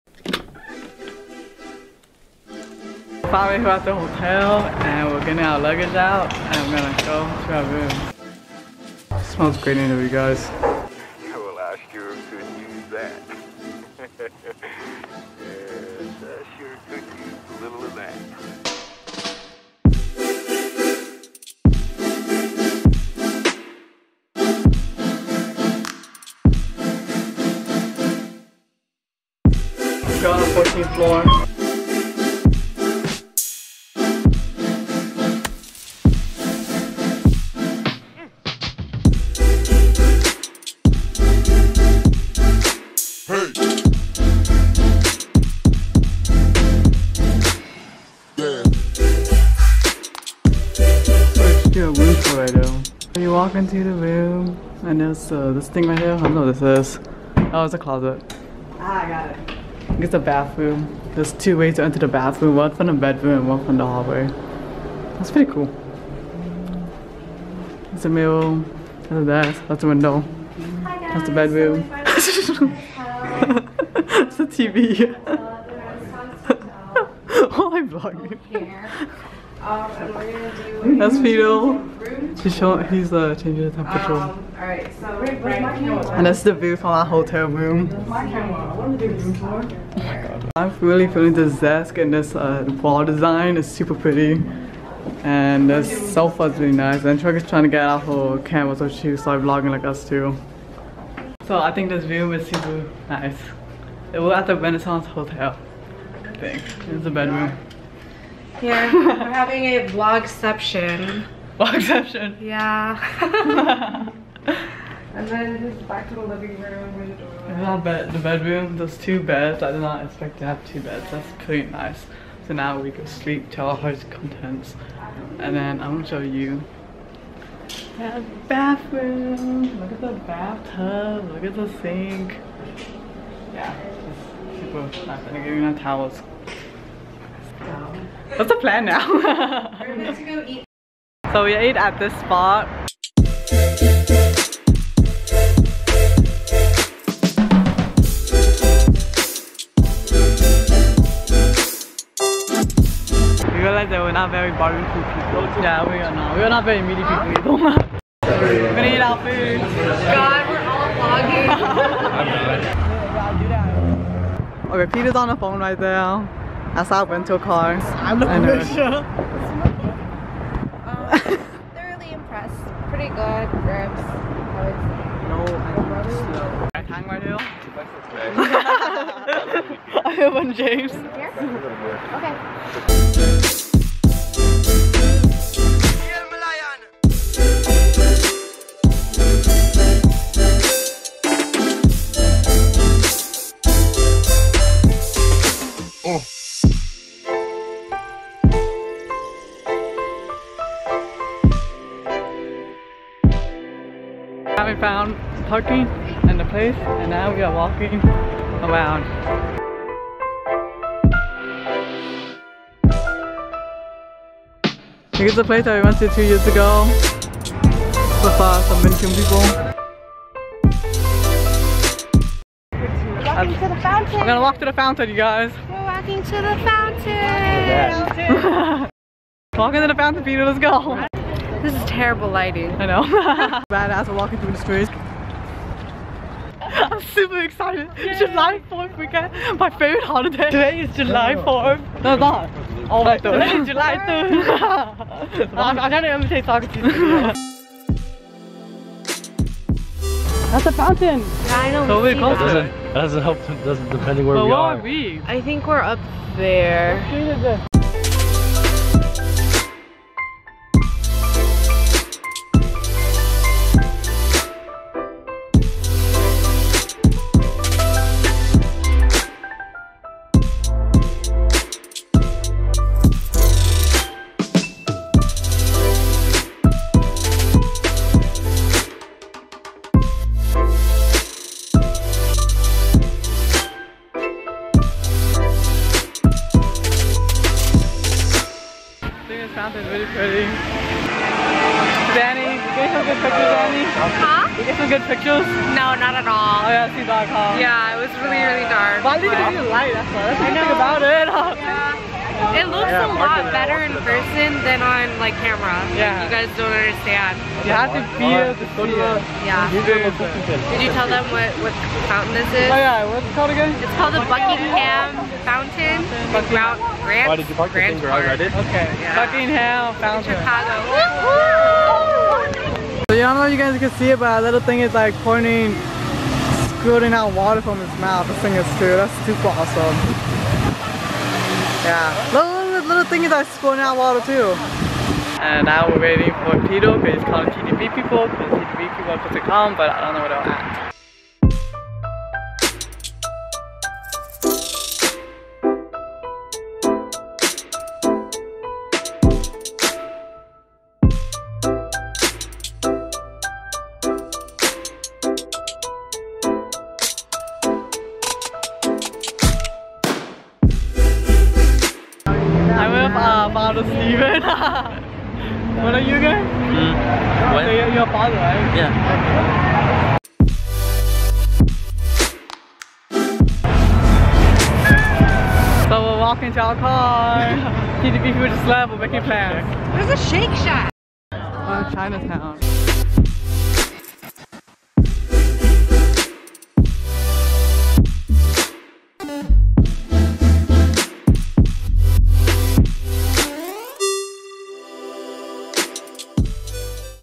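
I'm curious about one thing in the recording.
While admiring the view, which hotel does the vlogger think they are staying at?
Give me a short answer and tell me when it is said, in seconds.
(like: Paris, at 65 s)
Renaissance Hotel, at 104 s.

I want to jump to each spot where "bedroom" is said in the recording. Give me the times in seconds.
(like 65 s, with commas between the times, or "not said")
62 s, 71 s, 107 s, 118 s.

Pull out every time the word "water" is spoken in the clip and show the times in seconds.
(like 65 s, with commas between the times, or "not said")
327 s, 333 s.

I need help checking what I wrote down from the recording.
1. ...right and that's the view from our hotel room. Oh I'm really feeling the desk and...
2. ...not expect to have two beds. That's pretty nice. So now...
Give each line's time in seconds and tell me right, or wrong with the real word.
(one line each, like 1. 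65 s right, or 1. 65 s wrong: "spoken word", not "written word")
1. 85 s right
2. 119 s right.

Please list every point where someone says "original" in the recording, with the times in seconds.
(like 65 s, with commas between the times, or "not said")
not said.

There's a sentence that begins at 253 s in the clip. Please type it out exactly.
Doesn't depending where but we are.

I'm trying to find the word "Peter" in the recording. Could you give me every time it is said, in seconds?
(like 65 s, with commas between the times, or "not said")
164 s, 230 s.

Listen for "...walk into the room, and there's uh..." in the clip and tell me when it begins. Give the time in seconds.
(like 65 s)
53 s.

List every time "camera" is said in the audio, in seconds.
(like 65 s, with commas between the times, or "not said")
98 s, 305 s.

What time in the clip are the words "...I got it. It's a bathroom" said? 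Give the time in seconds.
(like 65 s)
59 s.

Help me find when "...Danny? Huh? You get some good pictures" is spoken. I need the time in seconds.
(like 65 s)
293 s.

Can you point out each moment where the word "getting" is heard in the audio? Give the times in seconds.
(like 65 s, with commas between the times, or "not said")
5 s.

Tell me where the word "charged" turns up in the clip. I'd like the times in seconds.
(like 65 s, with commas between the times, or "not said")
not said.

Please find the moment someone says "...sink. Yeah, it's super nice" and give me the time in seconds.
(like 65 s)
131 s.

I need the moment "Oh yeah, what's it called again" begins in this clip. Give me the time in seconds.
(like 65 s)
312 s.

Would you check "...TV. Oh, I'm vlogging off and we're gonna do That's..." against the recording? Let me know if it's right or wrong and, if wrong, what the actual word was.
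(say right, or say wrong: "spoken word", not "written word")
right.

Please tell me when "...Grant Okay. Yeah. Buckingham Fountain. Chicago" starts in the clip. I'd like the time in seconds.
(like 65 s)
317 s.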